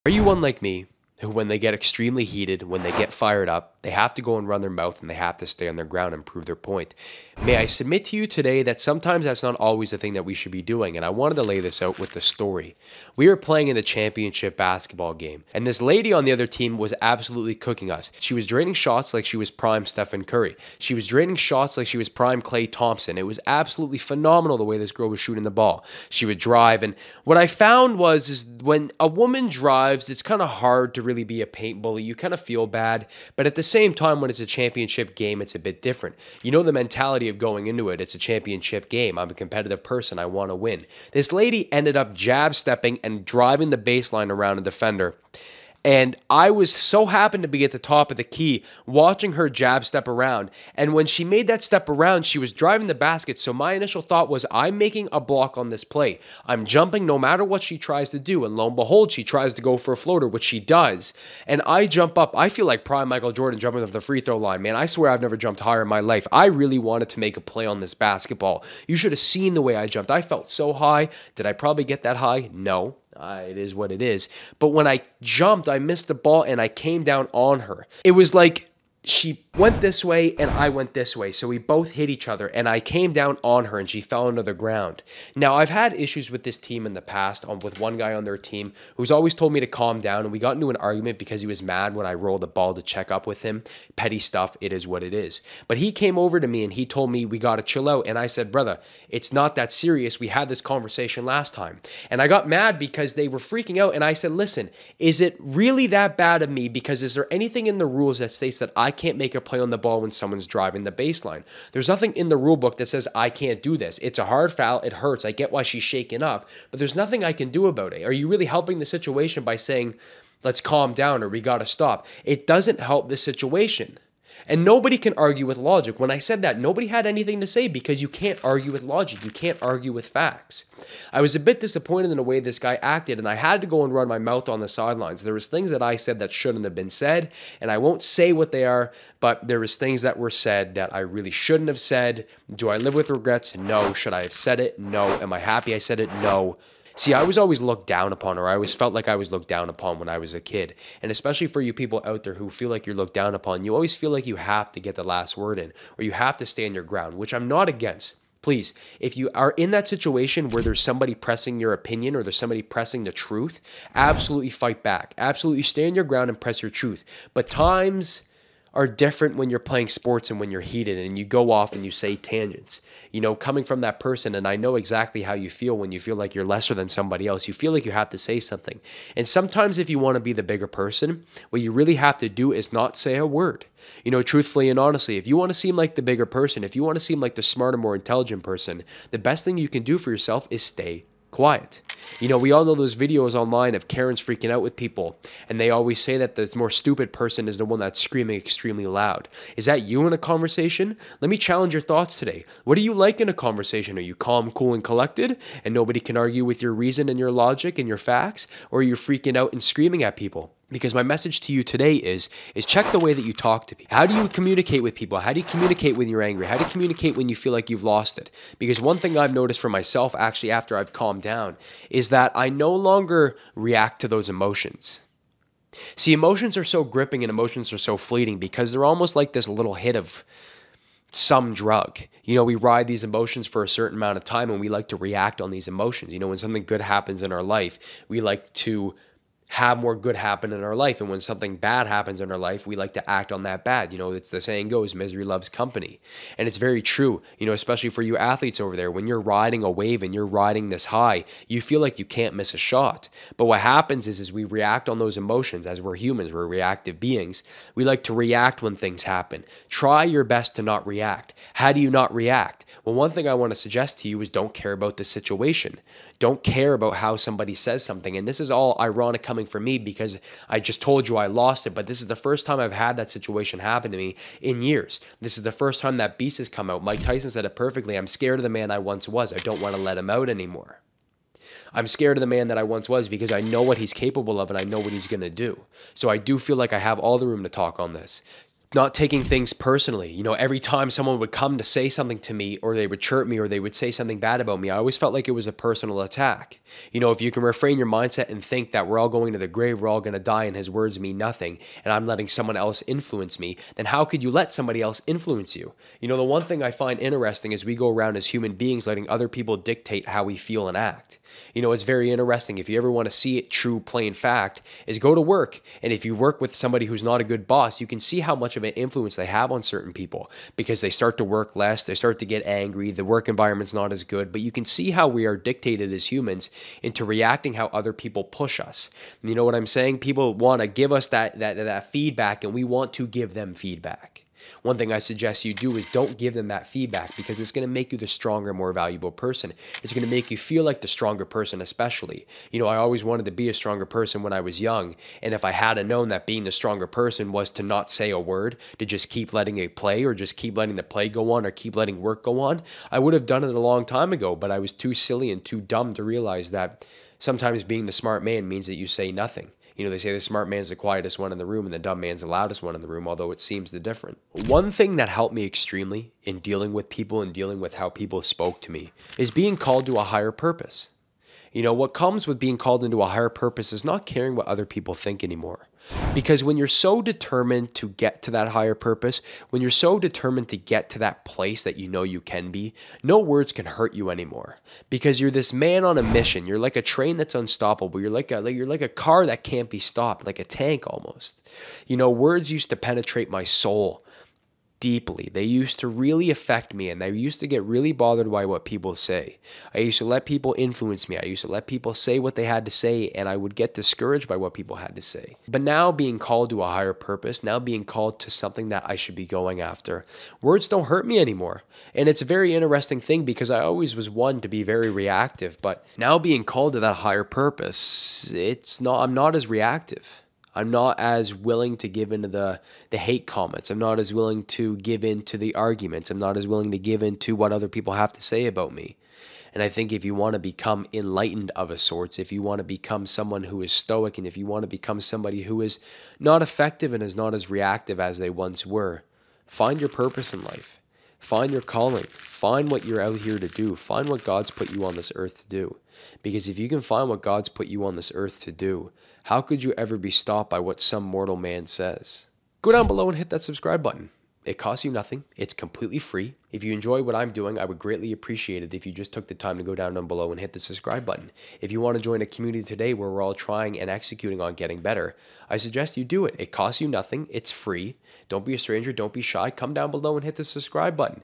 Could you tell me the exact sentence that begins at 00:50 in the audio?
And when she made that step around, she was driving the basket.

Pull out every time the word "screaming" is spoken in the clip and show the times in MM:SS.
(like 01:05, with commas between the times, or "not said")
03:17, 03:29.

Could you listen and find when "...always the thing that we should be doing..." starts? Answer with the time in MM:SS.
00:09.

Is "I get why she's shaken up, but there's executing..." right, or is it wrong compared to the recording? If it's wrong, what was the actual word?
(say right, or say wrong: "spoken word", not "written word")
wrong: "nothing", not "executing".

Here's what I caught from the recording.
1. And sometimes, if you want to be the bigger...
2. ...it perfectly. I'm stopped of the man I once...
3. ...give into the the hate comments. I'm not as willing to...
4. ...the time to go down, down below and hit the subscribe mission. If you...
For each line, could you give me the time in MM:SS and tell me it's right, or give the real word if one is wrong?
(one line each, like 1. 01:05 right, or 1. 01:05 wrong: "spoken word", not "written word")
1. 02:59 right
2. 04:37 wrong: "scared", not "stopped"
3. 07:01 right
4. 07:39 wrong: "button", not "mission".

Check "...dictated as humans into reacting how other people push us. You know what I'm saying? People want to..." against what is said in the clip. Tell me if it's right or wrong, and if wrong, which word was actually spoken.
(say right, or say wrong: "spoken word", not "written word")
right.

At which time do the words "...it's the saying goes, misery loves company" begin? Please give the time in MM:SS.
04:04.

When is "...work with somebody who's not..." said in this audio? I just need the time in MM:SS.
05:16.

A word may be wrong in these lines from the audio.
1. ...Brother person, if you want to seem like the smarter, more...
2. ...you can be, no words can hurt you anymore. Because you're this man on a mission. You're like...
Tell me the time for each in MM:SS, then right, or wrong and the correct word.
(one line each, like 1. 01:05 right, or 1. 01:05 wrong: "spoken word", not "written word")
1. 03:06 wrong: "bigger", not "Brother"
2. 06:22 right.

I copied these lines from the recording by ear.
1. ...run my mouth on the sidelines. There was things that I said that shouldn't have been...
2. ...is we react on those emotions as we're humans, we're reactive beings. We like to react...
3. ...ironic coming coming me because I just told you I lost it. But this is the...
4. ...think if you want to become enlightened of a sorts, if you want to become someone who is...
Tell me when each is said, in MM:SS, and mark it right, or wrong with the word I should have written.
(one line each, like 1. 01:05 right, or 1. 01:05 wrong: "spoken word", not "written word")
1. 02:13 right
2. 04:14 right
3. 04:28 right
4. 07:09 right.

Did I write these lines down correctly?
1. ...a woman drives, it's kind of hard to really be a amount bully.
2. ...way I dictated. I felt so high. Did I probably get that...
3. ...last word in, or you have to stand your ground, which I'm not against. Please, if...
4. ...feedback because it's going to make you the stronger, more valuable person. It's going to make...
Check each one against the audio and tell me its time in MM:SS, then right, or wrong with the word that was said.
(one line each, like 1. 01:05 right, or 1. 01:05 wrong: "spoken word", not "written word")
1. 00:28 wrong: "paint", not "amount"
2. 01:09 wrong: "jumped", not "dictated"
3. 02:35 right
4. 05:36 right.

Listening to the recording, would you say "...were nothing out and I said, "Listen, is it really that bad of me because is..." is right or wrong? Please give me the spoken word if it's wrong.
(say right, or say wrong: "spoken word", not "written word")
wrong: "freaking", not "nothing".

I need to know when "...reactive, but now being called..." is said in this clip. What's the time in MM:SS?
06:54.